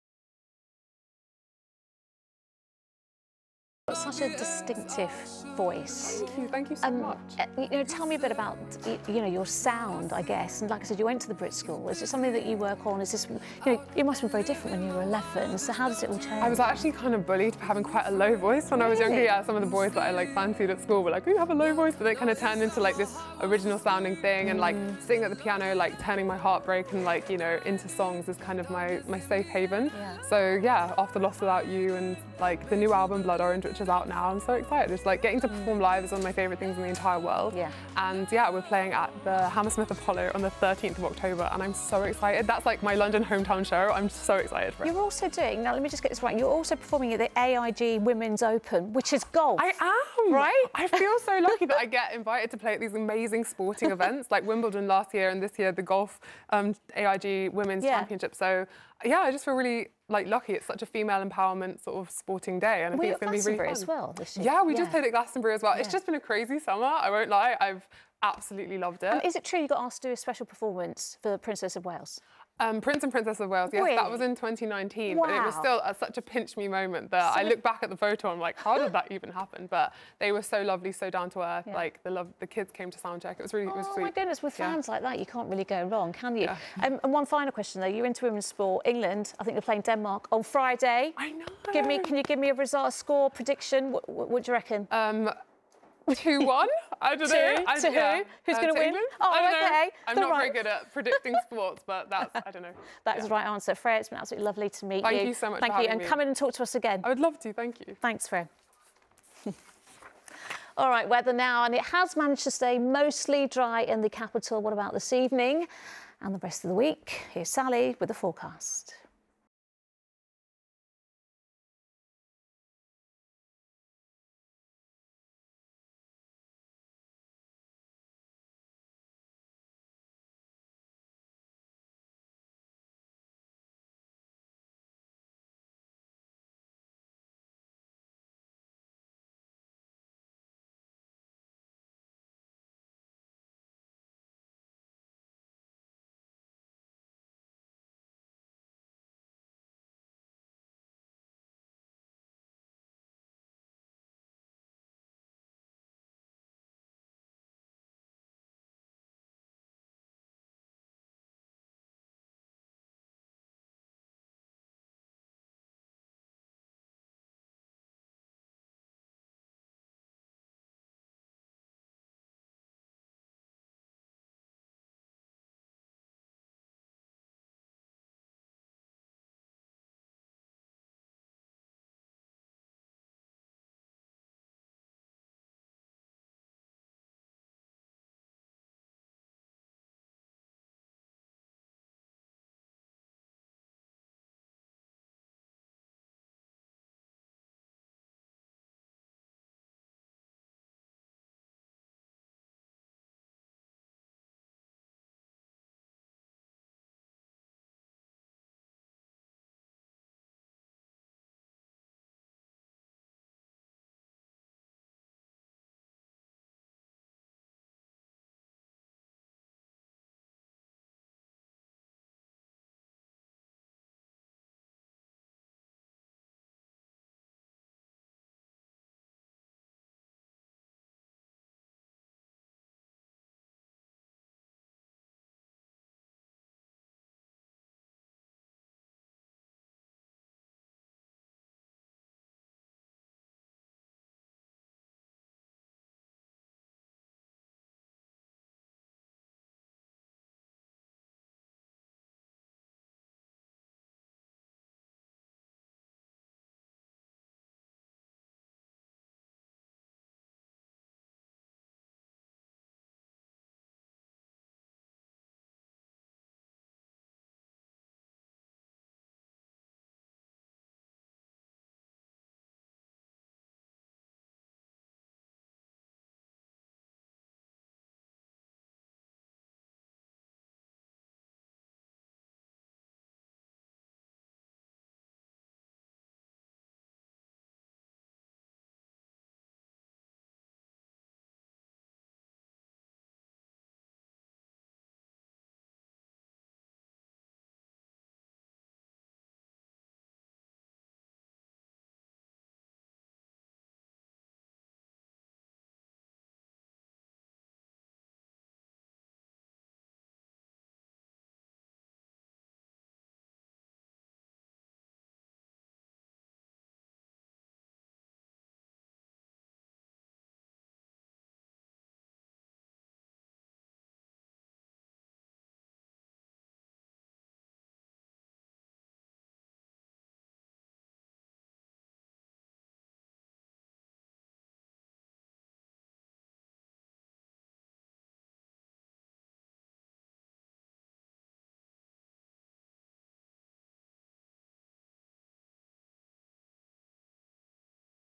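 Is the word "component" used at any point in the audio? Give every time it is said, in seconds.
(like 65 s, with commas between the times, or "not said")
not said.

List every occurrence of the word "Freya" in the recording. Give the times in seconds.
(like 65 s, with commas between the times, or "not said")
103 s, 108 s.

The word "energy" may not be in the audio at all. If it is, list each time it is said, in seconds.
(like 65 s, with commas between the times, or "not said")
not said.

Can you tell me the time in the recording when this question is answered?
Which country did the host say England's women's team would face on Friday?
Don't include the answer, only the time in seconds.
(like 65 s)
89 s.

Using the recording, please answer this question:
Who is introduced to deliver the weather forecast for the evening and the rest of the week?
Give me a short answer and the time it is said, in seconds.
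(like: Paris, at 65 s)
Sally, at 117 s.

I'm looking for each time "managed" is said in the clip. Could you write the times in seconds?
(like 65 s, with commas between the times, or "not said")
112 s.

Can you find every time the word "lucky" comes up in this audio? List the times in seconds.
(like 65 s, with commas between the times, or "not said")
51 s, 60 s.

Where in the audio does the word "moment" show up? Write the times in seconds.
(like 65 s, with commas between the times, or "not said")
76 s.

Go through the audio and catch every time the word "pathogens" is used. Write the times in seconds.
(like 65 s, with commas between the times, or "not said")
not said.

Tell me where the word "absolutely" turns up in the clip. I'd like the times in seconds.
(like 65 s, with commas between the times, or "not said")
68 s, 104 s.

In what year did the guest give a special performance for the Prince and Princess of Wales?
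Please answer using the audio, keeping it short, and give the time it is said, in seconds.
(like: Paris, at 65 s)
2019, at 74 s.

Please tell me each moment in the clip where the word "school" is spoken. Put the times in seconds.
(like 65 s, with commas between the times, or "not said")
11 s, 20 s.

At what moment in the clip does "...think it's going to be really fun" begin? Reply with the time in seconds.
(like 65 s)
63 s.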